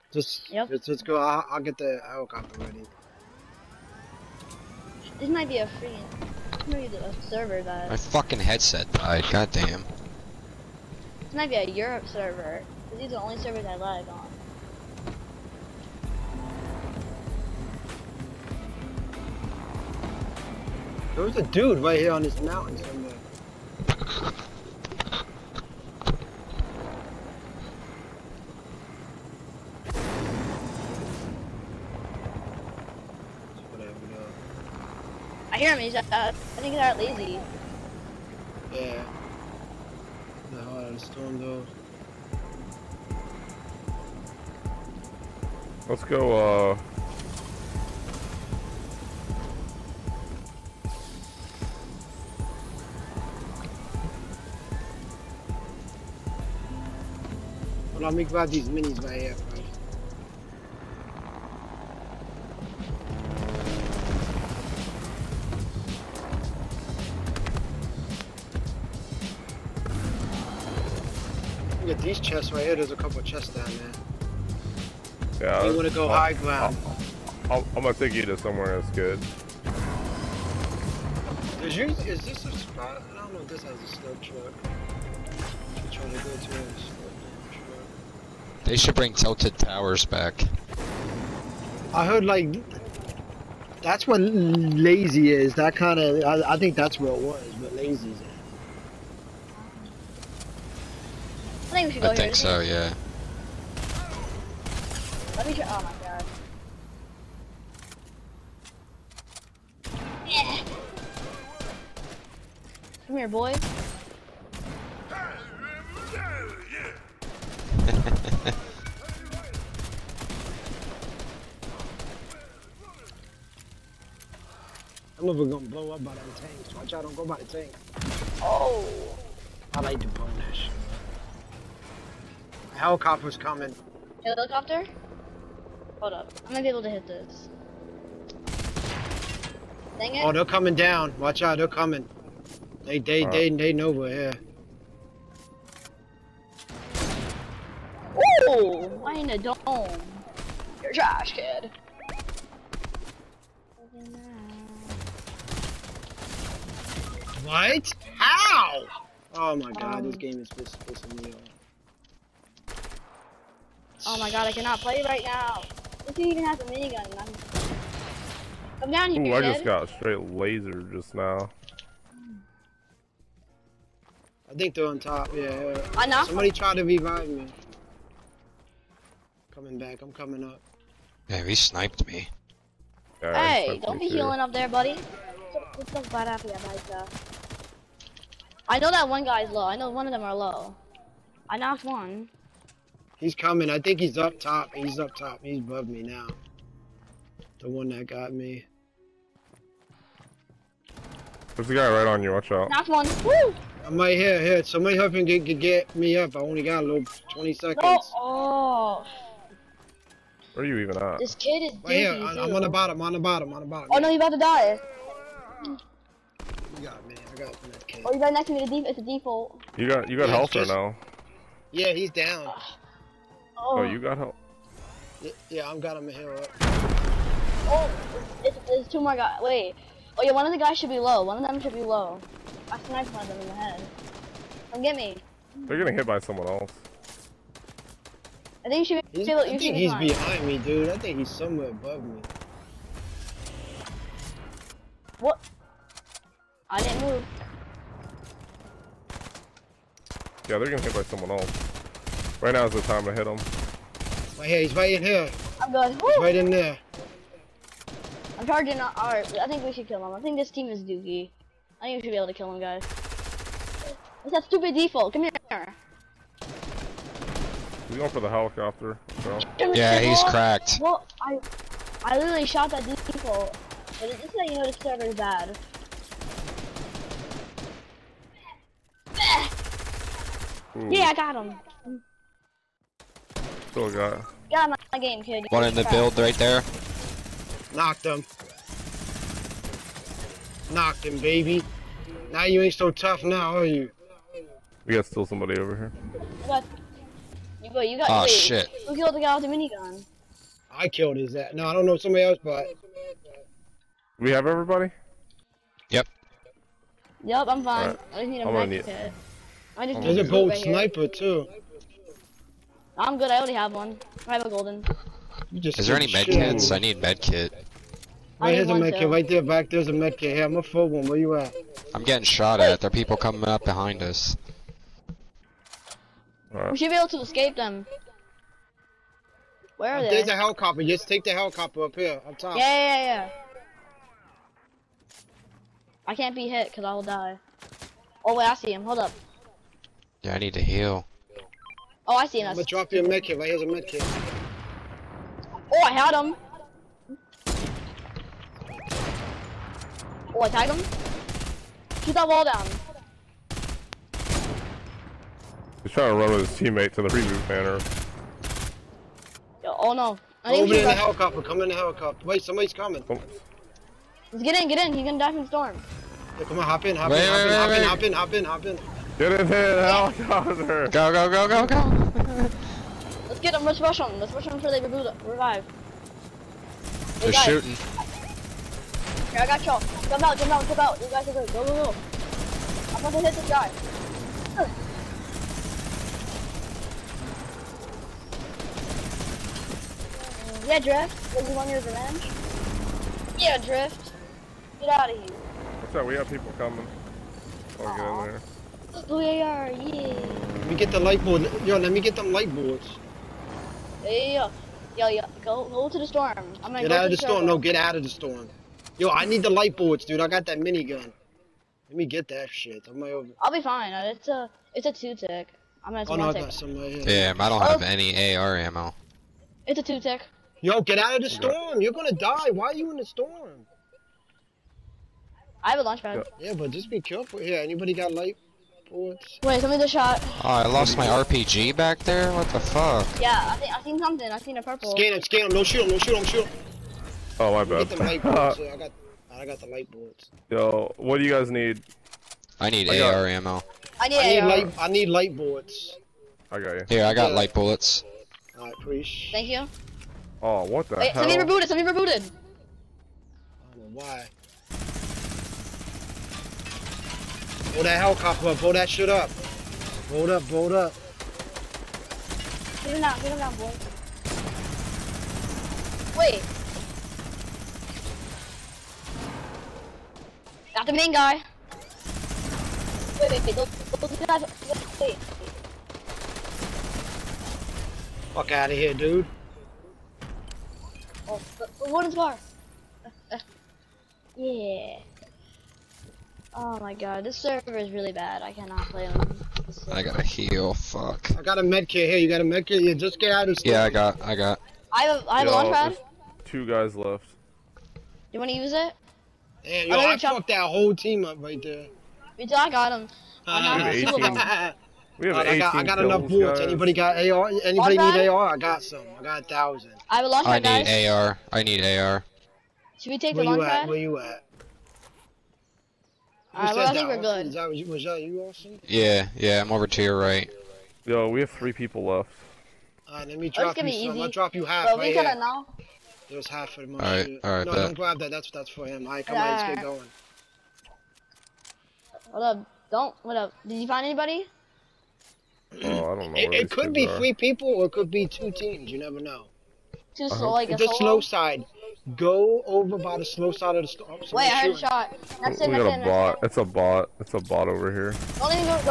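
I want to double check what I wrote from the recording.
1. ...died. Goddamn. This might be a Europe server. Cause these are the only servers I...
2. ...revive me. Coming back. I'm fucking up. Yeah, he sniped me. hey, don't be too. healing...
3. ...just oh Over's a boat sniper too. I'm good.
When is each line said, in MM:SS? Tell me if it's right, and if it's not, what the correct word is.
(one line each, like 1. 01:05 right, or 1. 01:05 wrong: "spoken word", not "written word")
1. 00:08 right
2. 02:56 wrong: "coming", not "fucking"
3. 05:09 wrong: "There", not "Over".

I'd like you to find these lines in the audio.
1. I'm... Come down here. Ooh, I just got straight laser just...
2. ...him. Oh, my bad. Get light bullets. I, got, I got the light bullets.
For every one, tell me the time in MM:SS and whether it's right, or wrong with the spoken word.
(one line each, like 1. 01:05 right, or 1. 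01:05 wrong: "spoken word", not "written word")
1. 02:47 right
2. 07:16 right.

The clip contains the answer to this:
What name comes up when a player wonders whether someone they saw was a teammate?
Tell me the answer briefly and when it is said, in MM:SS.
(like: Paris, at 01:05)
Austin, at 08:38.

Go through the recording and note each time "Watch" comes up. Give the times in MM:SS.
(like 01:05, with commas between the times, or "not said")
02:06, 02:21, 03:22.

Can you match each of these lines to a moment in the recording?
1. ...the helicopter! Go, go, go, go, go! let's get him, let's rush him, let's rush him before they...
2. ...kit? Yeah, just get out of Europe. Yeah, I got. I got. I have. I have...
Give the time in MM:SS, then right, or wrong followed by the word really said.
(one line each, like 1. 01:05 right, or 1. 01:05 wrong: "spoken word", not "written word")
1. 06:09 right
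2. 08:12 wrong: "Stay", not "Europe".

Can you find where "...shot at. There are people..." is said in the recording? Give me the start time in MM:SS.
05:22.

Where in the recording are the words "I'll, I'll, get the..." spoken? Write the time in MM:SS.
00:01.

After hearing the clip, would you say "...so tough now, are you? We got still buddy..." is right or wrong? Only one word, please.
wrong.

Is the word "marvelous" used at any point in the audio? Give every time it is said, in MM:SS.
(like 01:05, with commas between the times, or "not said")
not said.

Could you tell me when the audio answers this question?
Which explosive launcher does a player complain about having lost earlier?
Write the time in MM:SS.
07:11.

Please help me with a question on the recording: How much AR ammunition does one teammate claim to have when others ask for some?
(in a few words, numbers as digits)
1000.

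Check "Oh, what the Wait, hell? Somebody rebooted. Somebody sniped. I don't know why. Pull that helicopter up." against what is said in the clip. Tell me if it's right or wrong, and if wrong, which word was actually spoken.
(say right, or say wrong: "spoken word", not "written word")
wrong: "rebooted", not "sniped".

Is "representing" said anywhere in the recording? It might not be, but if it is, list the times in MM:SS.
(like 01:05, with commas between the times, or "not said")
not said.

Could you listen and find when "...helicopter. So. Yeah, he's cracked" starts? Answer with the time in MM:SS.
04:28.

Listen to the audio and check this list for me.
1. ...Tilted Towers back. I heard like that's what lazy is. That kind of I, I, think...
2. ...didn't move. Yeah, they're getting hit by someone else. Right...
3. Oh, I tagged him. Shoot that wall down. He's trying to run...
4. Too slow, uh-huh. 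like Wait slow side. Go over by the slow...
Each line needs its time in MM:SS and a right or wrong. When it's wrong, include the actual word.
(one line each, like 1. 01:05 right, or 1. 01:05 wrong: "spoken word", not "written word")
1. 01:29 right
2. 04:06 right
3. 05:50 right
4. 09:00 wrong: "The", not "Wait".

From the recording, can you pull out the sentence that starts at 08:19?
Yeah, yo, I, I fucked that whole team up right there.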